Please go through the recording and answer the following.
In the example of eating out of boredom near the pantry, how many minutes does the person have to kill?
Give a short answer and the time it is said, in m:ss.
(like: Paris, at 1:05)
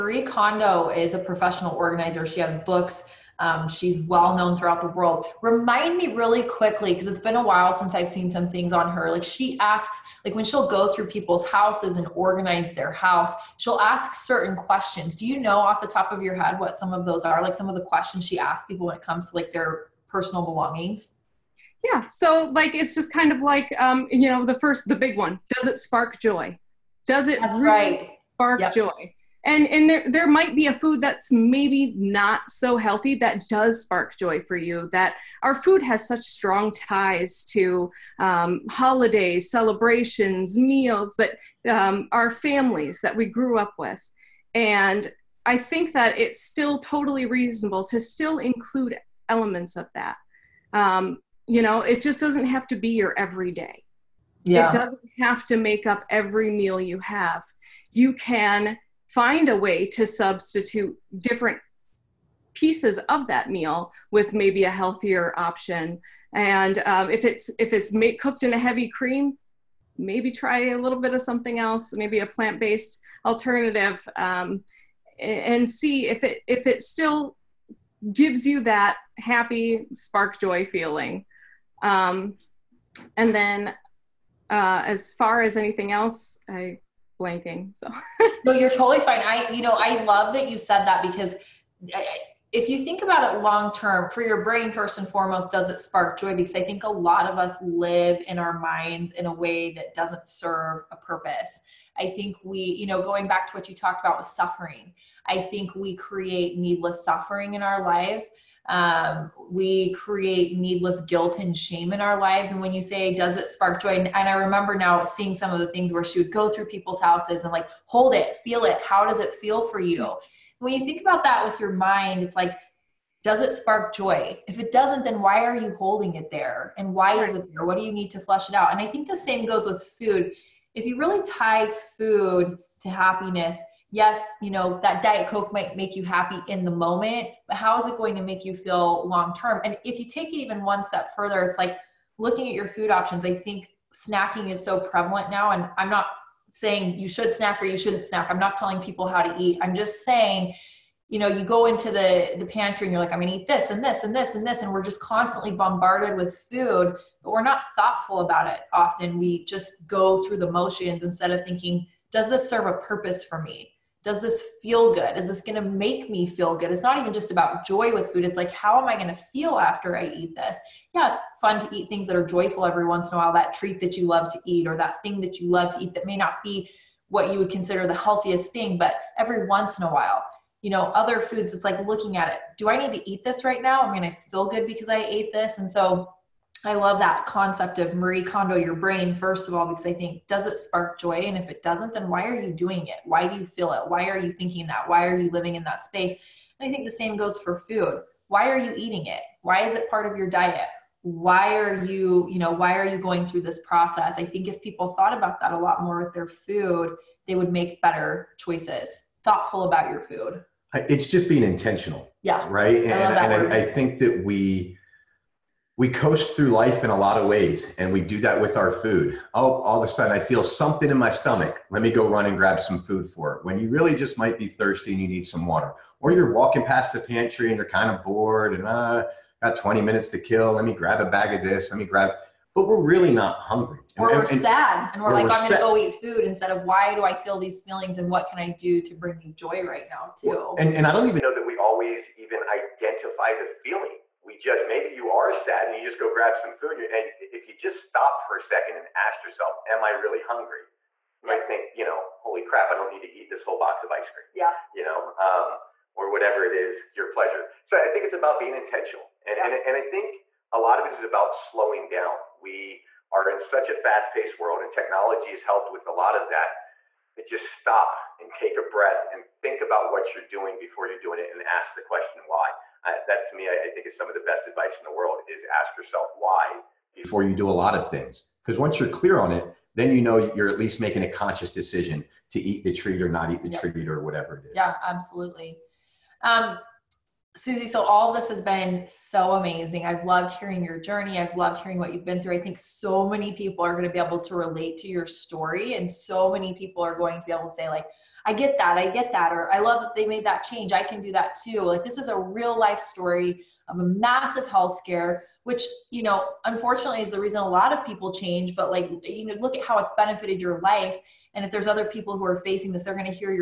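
20, at 3:49.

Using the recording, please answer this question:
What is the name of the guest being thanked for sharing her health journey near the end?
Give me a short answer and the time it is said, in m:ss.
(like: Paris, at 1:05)
Suzie, at 4:47.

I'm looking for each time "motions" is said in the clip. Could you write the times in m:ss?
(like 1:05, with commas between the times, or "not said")
2:40.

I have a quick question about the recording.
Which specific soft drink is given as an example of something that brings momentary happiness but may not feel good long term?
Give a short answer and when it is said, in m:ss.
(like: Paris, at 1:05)
Diet Coke, at 2:15.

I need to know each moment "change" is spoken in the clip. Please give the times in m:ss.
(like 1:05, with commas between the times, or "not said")
5:00, 5:08.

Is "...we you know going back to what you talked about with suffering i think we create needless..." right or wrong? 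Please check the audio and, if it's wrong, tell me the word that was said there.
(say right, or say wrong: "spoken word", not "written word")
right.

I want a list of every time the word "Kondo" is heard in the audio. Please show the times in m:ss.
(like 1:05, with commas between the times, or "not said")
0:00, 3:08.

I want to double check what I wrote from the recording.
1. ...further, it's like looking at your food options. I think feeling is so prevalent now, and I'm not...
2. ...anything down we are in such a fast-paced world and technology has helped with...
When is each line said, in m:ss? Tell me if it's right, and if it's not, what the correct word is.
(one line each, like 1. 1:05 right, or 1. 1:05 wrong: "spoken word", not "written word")
1. 2:21 wrong: "snacking", not "feeling"
2. 4:21 wrong: "slowing", not "anything".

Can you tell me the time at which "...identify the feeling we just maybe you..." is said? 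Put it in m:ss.
4:02.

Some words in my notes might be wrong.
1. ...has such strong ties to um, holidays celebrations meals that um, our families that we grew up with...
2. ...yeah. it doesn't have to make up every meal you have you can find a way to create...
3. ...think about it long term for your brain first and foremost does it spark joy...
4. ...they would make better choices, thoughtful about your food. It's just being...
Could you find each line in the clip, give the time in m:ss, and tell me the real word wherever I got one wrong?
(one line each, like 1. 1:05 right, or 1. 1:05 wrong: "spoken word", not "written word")
1. 0:35 right
2. 0:54 wrong: "substitute", not "create"
3. 1:32 right
4. 3:27 right.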